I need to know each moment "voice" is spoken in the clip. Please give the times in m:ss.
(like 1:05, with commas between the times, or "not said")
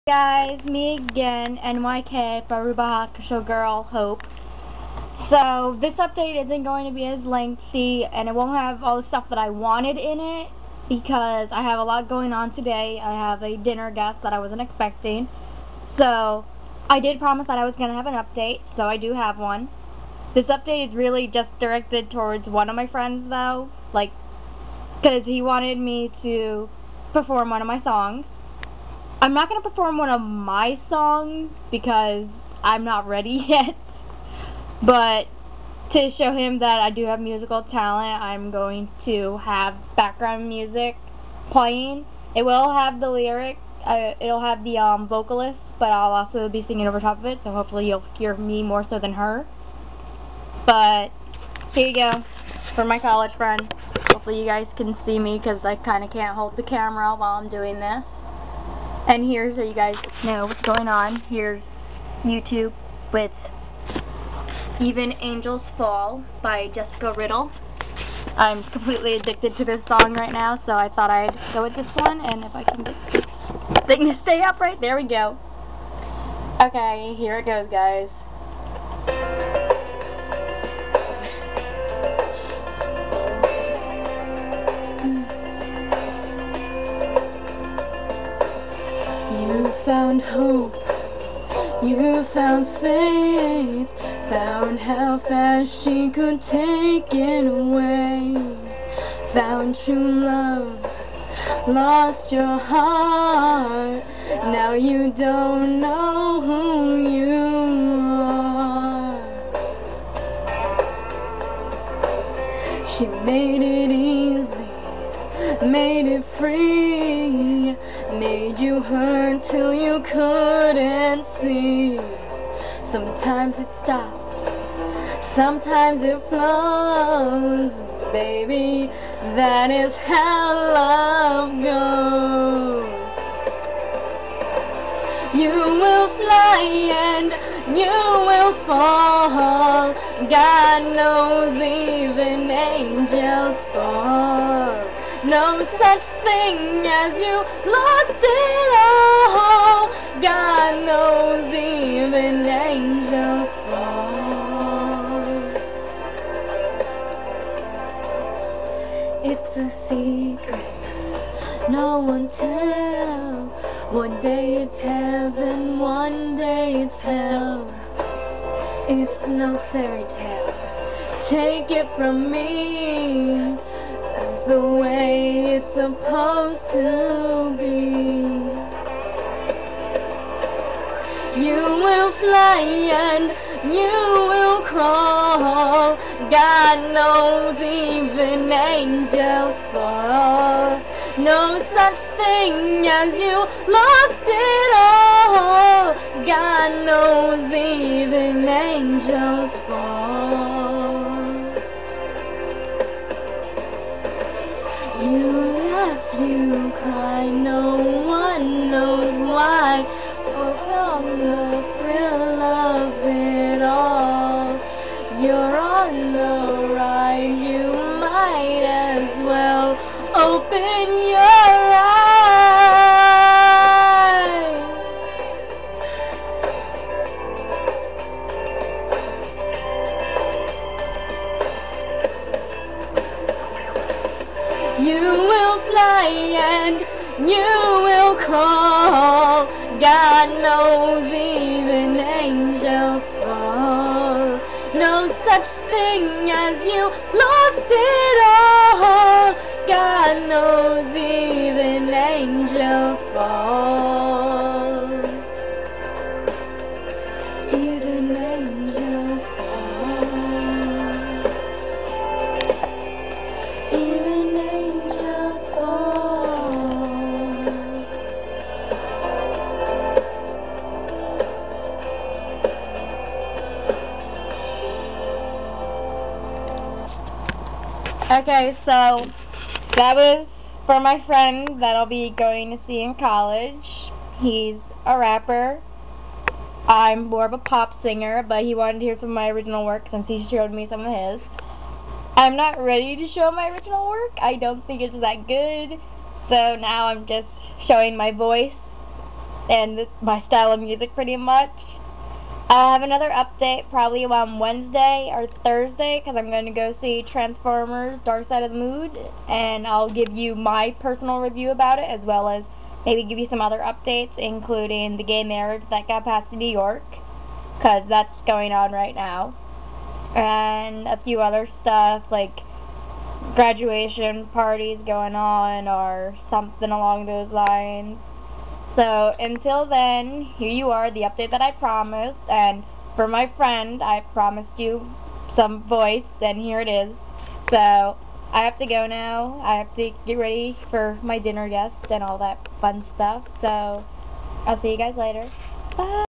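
4:58, 5:35.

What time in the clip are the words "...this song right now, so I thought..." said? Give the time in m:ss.
1:09.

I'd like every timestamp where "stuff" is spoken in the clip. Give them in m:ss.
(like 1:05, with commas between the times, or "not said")
0:09, 5:21, 5:42.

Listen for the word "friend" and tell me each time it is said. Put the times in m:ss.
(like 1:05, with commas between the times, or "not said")
0:22, 0:53, 4:41, 5:33.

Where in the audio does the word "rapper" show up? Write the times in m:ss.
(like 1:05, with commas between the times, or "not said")
4:44.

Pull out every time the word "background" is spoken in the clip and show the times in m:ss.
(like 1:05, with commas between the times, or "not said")
0:39.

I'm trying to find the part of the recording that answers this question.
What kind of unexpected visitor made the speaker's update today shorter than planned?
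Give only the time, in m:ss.
0:13.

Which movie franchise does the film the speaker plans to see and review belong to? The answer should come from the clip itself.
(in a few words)
Transformers.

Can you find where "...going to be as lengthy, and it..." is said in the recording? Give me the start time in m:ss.
0:06.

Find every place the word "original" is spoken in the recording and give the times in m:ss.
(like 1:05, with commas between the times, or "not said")
4:49, 4:53.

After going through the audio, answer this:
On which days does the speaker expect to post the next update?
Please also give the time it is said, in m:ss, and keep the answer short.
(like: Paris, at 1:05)
Wednesday or Thursday, at 5:04.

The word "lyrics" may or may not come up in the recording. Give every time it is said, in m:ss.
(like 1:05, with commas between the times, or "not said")
0:43.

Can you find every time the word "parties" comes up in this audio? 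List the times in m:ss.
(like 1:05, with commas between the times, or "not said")
5:24.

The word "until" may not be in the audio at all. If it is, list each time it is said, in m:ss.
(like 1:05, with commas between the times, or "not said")
5:29.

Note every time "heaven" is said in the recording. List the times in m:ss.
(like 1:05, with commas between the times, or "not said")
2:44.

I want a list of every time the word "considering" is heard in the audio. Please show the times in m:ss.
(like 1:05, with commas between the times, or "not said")
not said.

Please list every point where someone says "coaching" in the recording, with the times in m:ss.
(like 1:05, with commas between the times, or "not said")
not said.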